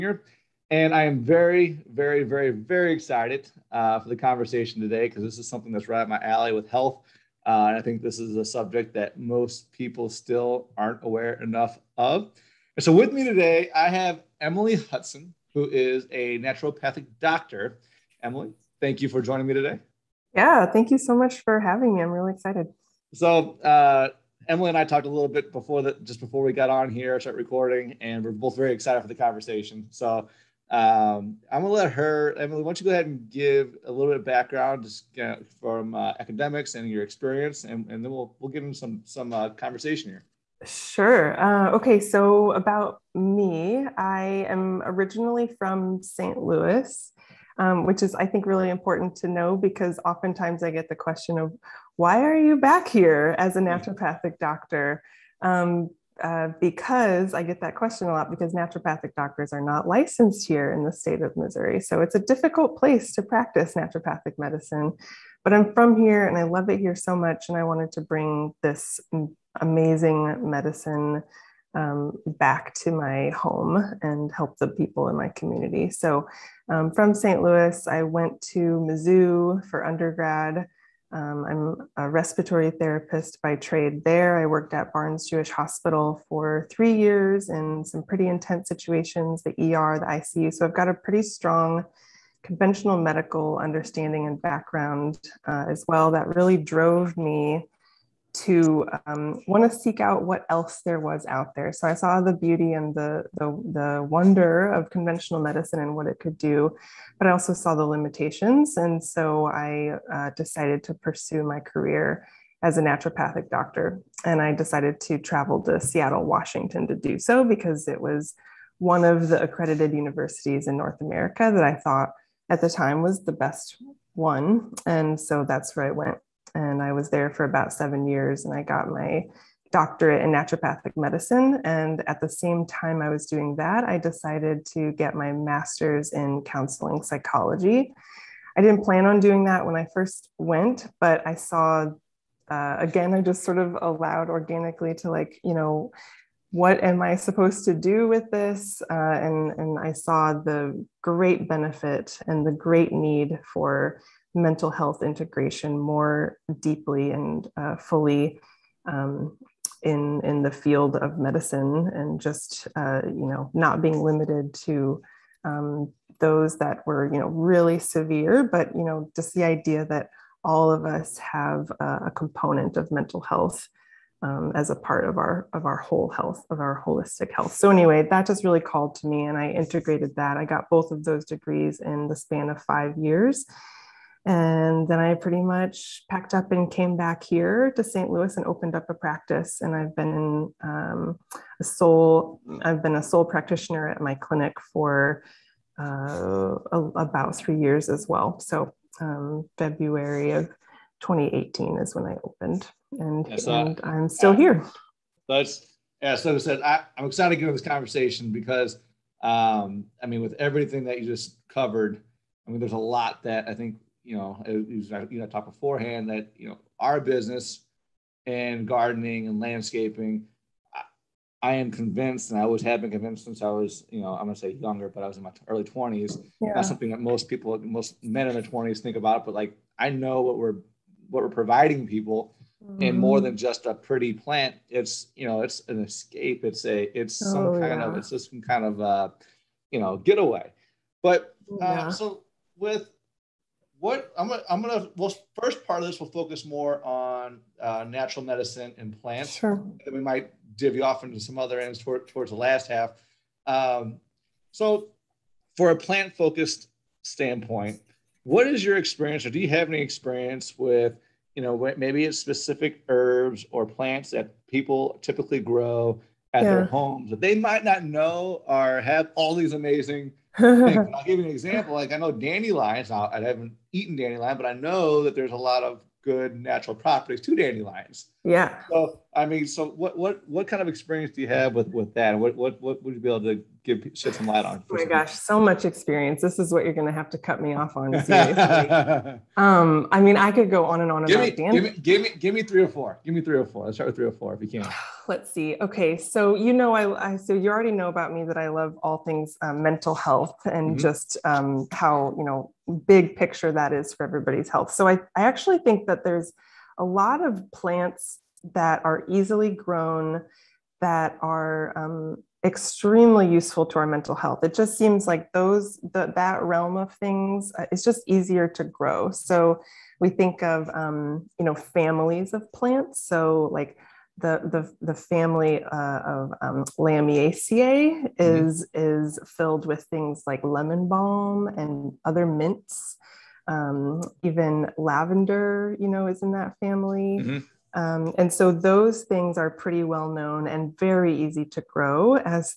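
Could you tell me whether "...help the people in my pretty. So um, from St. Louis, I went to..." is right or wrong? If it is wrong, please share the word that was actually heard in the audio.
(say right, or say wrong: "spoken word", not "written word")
wrong: "community", not "pretty".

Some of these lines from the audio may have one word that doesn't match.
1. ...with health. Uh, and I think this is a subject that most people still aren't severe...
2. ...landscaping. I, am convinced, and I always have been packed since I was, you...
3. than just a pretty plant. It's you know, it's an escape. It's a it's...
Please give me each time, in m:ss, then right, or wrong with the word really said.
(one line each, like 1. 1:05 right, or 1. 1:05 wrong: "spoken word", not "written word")
1. 0:06 wrong: "aware", not "severe"
2. 3:39 wrong: "convinced", not "packed"
3. 3:53 right.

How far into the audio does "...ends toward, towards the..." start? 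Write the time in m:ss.
4:11.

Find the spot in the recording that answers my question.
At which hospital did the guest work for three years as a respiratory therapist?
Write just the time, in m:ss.
1:24.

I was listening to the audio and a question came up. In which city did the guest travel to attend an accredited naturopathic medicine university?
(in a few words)
Seattle, Washington.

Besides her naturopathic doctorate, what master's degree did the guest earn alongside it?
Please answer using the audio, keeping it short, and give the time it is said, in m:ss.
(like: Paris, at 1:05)
Counseling psychology, at 2:16.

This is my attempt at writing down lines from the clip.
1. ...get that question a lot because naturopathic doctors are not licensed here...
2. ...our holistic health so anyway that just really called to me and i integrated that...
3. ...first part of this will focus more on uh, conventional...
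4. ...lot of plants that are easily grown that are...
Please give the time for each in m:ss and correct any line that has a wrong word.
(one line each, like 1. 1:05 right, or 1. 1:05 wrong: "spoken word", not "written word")
1. 0:57 right
2. 2:56 right
3. 4:05 wrong: "natural", not "conventional"
4. 5:06 right.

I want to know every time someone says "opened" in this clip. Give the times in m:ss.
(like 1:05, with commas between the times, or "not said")
3:08, 3:22.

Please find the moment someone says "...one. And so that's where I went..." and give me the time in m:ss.
2:04.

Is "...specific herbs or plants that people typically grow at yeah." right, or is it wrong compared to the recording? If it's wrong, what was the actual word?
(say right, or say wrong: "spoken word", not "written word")
right.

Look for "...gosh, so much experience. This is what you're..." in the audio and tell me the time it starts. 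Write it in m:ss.
4:44.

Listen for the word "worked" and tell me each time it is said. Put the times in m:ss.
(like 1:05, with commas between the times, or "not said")
1:24.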